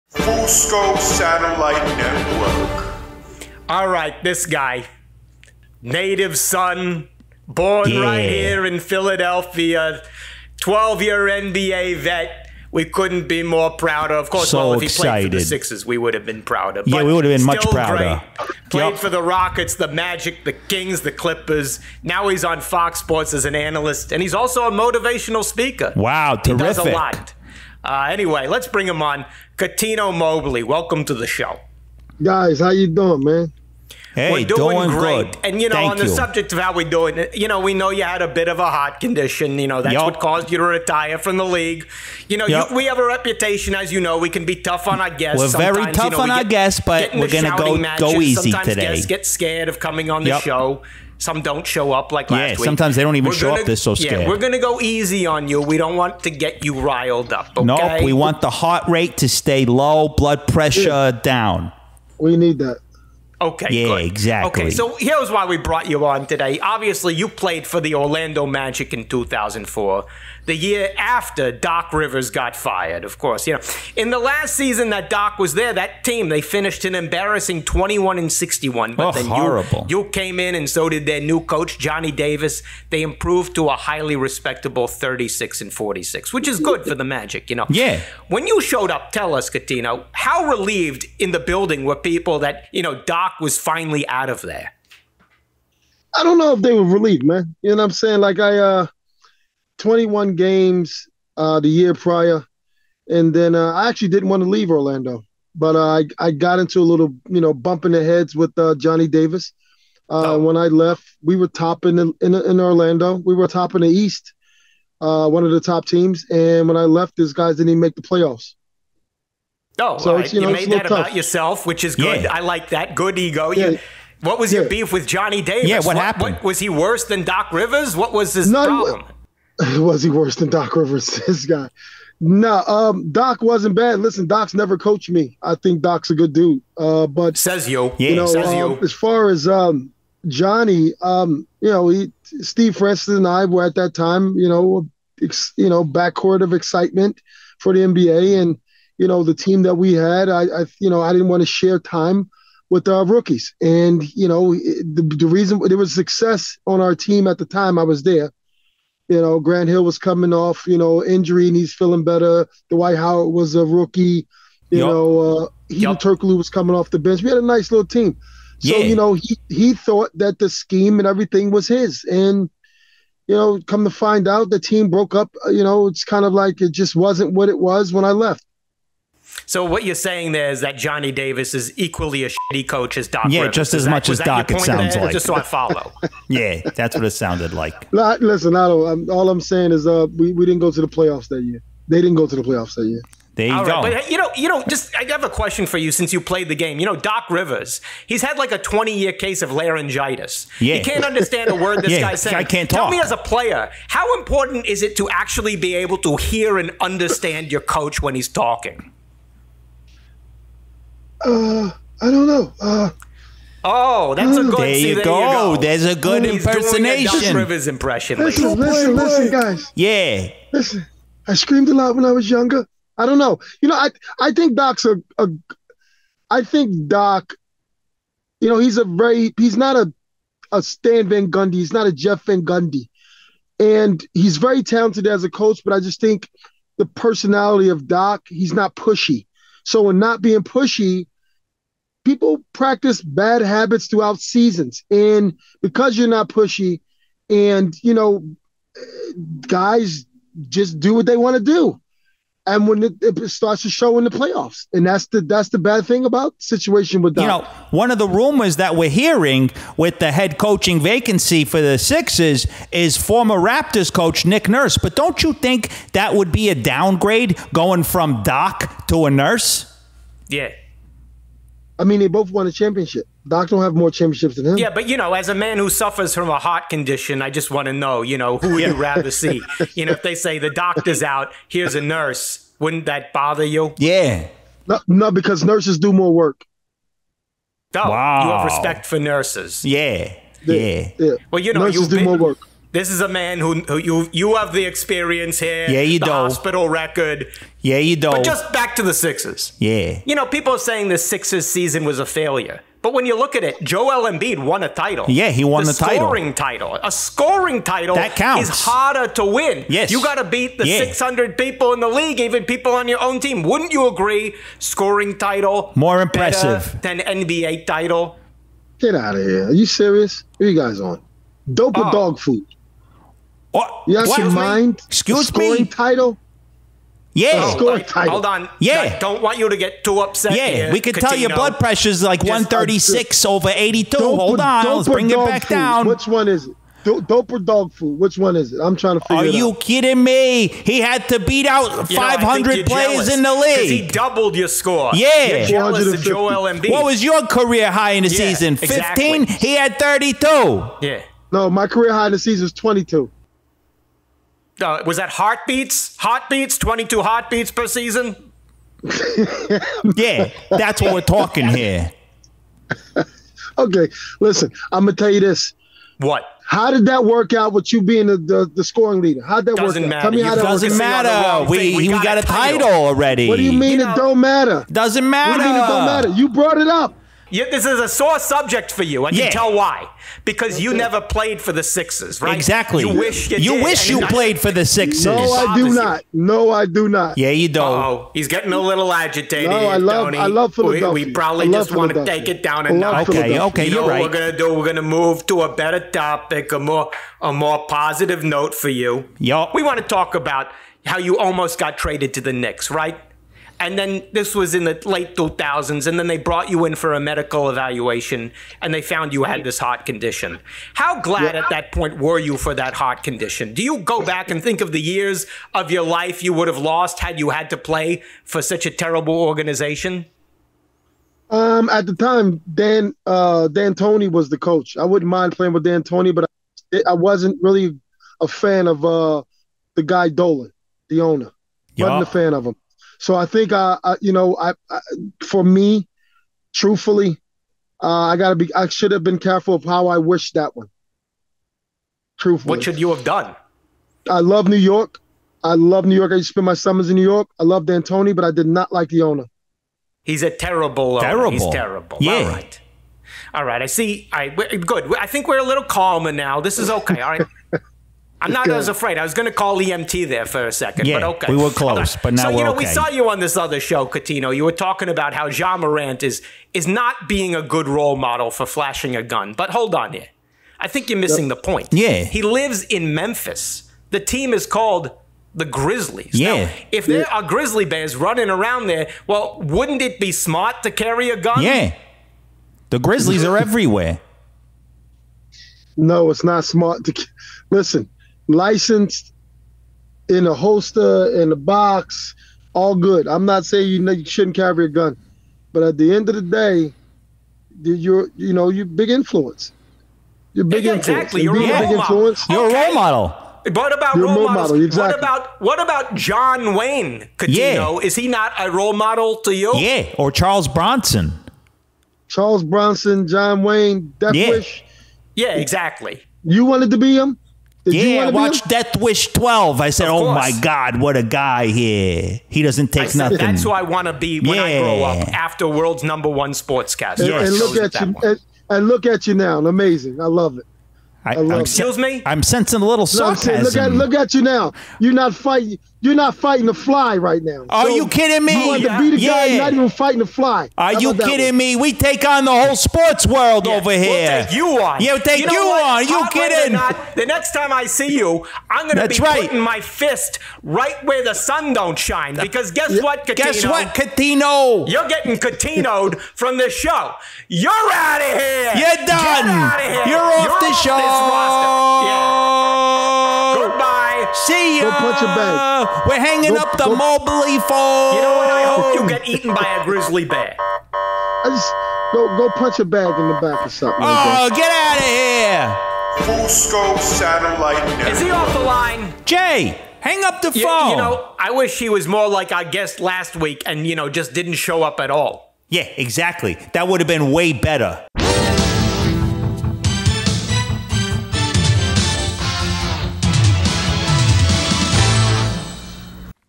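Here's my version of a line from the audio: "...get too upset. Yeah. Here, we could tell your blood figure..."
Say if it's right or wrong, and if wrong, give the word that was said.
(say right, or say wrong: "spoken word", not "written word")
wrong: "pressure", not "figure".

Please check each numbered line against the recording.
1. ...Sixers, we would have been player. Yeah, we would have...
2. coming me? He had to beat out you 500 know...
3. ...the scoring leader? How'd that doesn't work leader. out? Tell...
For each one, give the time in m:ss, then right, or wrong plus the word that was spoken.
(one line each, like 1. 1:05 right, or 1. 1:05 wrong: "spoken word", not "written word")
1. 0:15 wrong: "prouder", not "player"
2. 5:39 wrong: "kidding", not "coming"
3. 6:08 wrong: "matter", not "leader".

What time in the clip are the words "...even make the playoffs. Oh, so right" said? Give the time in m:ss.
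1:57.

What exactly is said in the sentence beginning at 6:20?
Because you never played for the Sixers, right?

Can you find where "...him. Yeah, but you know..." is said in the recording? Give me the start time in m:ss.
4:34.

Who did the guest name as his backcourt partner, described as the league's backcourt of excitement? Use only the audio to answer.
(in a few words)
Steve Francis.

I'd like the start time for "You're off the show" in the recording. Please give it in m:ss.
9:19.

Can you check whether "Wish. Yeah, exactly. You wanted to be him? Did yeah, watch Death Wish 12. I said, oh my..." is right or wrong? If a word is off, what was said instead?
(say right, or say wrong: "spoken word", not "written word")
right.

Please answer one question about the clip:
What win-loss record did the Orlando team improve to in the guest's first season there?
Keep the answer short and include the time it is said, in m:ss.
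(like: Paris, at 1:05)
36 and 46, at 1:24.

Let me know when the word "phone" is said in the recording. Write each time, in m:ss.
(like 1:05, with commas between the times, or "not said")
9:27, 9:40.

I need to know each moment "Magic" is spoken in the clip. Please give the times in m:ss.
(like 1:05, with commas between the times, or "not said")
0:19, 1:08, 1:27.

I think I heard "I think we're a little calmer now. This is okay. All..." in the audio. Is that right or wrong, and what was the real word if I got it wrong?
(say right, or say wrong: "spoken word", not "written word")
right.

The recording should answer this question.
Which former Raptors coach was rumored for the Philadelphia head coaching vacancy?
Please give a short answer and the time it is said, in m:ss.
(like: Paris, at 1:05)
Nick Nurse, at 4:24.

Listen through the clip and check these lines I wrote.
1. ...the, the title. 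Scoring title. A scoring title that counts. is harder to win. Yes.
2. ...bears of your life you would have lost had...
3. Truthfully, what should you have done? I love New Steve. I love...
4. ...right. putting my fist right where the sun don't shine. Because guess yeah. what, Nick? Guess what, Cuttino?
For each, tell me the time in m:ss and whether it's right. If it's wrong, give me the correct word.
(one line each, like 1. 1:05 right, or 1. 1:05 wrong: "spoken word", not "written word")
1. 5:05 right
2. 6:54 wrong: "years", not "bears"
3. 7:22 wrong: "York", not "Steve"
4. 9:09 wrong: "Cuttino", not "Nick".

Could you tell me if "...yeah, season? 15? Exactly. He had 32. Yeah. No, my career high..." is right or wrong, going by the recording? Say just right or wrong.
right.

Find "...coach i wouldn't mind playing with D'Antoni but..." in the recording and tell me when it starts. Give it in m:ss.
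7:04.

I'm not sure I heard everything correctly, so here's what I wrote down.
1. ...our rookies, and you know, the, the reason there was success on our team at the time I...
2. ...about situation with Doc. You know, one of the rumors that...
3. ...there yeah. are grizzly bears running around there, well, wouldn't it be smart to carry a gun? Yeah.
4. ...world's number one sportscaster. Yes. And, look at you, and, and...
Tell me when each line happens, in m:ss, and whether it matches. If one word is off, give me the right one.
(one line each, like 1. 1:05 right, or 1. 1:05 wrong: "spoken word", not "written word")
1. 2:32 right
2. 4:16 right
3. 7:56 right
4. 8:45 right.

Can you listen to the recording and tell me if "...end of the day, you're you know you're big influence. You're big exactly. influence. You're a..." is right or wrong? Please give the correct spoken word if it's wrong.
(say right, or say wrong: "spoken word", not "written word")
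right.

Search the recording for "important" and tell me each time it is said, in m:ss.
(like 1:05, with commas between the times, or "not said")
3:24.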